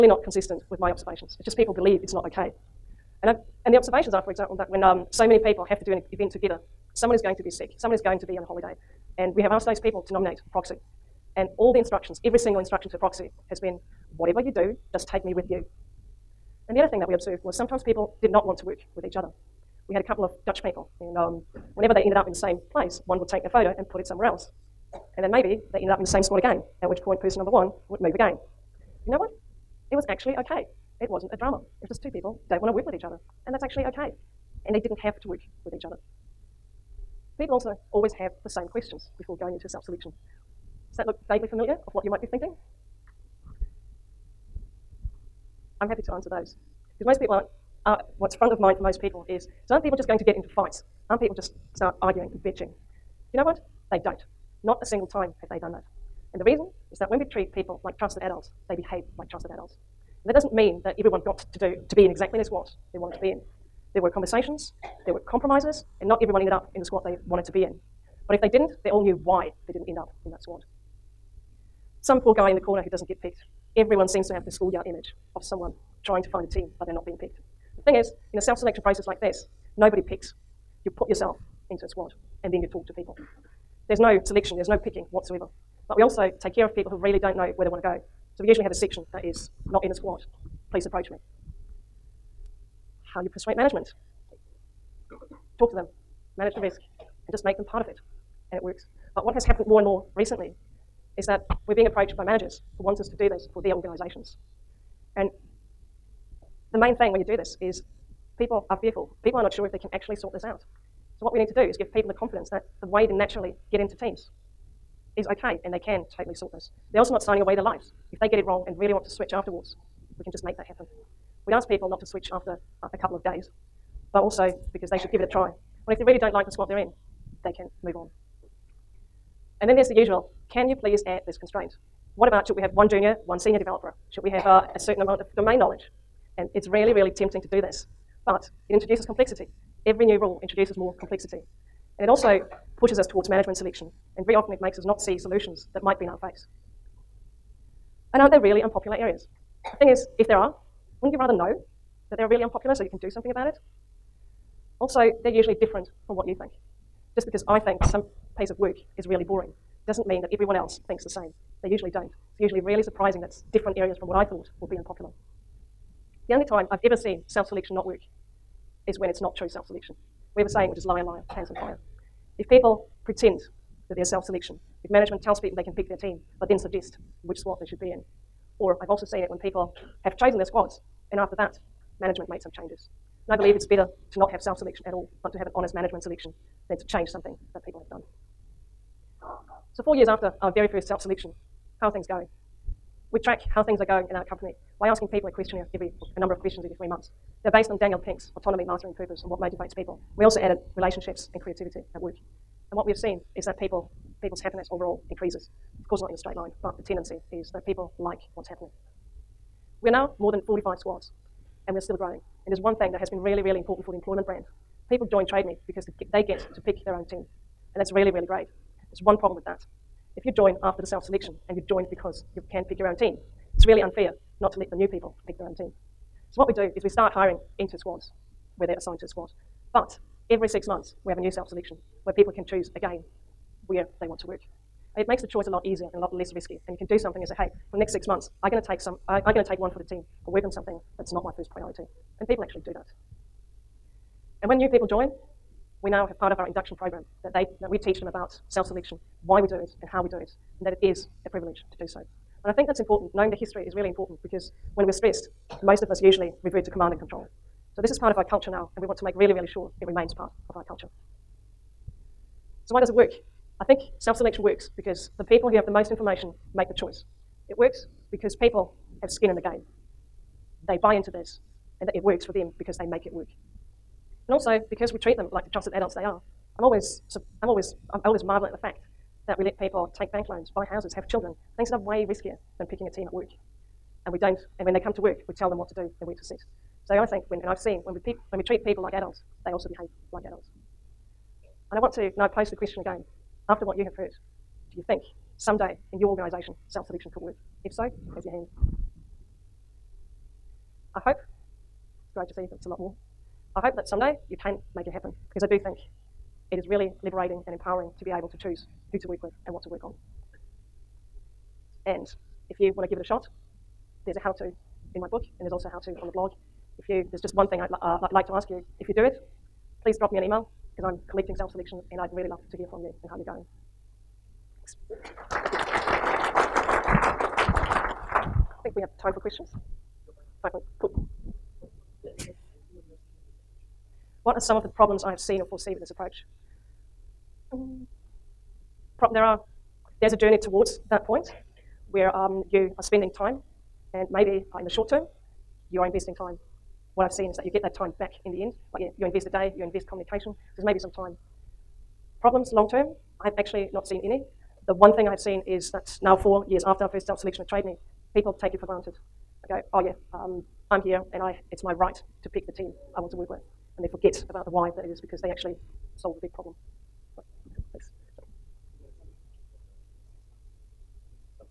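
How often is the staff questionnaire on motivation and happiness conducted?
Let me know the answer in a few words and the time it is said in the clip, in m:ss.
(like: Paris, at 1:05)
every 3 months, at 3:16.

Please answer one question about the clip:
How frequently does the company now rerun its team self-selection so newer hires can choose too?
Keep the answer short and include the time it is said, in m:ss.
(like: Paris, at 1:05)
every 6 months, at 3:50.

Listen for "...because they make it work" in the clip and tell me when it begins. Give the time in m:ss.
4:32.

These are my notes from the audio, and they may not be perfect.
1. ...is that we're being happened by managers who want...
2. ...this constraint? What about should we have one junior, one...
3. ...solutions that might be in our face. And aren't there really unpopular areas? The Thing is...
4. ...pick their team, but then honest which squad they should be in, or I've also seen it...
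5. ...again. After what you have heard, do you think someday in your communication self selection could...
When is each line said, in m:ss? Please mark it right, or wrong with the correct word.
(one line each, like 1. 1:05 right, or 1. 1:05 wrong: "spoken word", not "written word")
1. 1:41 wrong: "approached", not "happened"
2. 2:11 right
3. 2:25 right
4. 2:55 wrong: "suggest", not "honest"
5. 4:52 wrong: "organisation", not "communication".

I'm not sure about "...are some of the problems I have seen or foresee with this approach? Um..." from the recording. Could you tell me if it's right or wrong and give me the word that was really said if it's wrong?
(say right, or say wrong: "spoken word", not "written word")
right.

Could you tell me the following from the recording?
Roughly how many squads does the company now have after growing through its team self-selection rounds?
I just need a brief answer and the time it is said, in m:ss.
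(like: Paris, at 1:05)
more than 45, at 3:30.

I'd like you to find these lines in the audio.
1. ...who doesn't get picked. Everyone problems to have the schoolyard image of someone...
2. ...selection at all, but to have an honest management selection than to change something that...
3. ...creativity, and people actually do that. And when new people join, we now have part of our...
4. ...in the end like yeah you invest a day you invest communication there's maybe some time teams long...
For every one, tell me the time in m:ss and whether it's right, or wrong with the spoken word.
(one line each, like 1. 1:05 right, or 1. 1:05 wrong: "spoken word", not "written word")
1. 1:12 wrong: "seems", not "problems"
2. 3:04 right
3. 4:01 wrong: "priority", not "creativity"
4. 5:48 wrong: "problems", not "teams".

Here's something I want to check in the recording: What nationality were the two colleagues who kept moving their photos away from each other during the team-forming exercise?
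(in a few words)
Dutch.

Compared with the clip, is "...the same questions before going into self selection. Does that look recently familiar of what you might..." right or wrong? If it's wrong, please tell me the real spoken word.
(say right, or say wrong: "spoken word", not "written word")
wrong: "vaguely", not "recently".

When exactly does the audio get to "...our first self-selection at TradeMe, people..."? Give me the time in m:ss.
5:56.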